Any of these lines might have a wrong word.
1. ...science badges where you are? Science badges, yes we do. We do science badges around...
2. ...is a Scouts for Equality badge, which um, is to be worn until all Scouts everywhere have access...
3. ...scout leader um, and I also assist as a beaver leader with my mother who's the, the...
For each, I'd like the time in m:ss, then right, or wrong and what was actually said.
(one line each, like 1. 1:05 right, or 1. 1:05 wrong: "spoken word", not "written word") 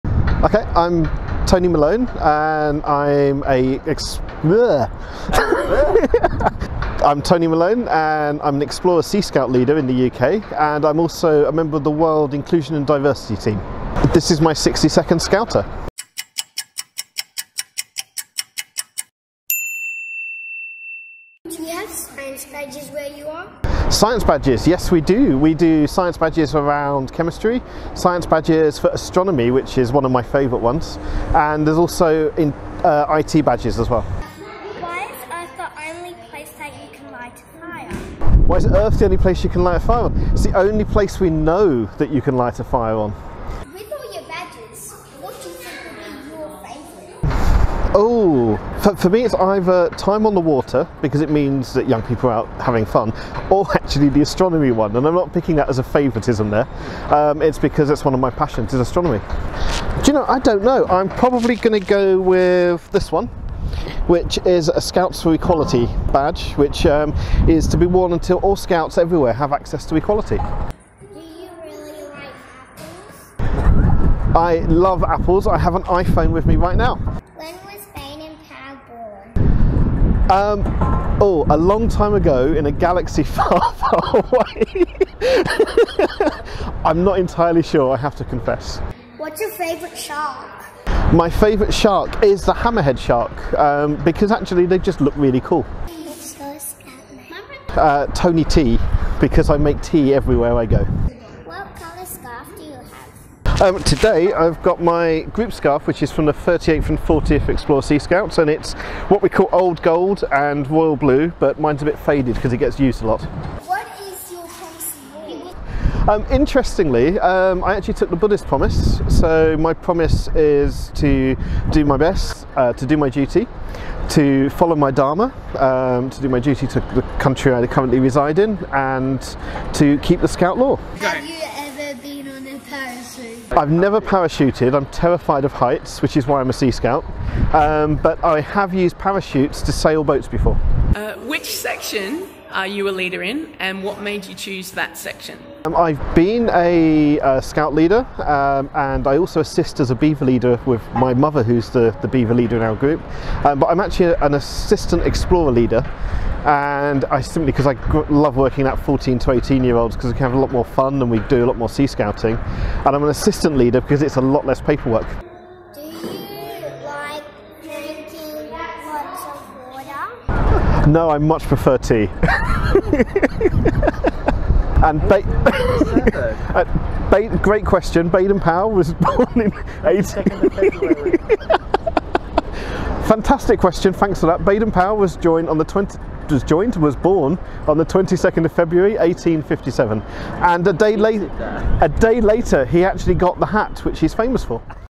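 1. 0:21 right
2. 1:04 right
3. 2:27 right.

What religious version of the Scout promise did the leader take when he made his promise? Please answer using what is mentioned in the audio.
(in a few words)
Buddhist promise.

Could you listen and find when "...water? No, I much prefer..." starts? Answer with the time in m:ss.
2:49.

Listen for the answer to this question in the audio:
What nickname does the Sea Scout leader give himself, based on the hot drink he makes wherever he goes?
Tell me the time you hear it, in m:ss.
1:38.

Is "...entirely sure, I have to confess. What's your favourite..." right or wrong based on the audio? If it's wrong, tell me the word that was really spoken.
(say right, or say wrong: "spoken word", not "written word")
right.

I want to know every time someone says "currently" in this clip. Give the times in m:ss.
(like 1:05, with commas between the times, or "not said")
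2:07.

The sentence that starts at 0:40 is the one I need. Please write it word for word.
It's the only place we know that you can light a fire on.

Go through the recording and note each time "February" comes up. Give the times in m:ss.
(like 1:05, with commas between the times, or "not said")
3:08.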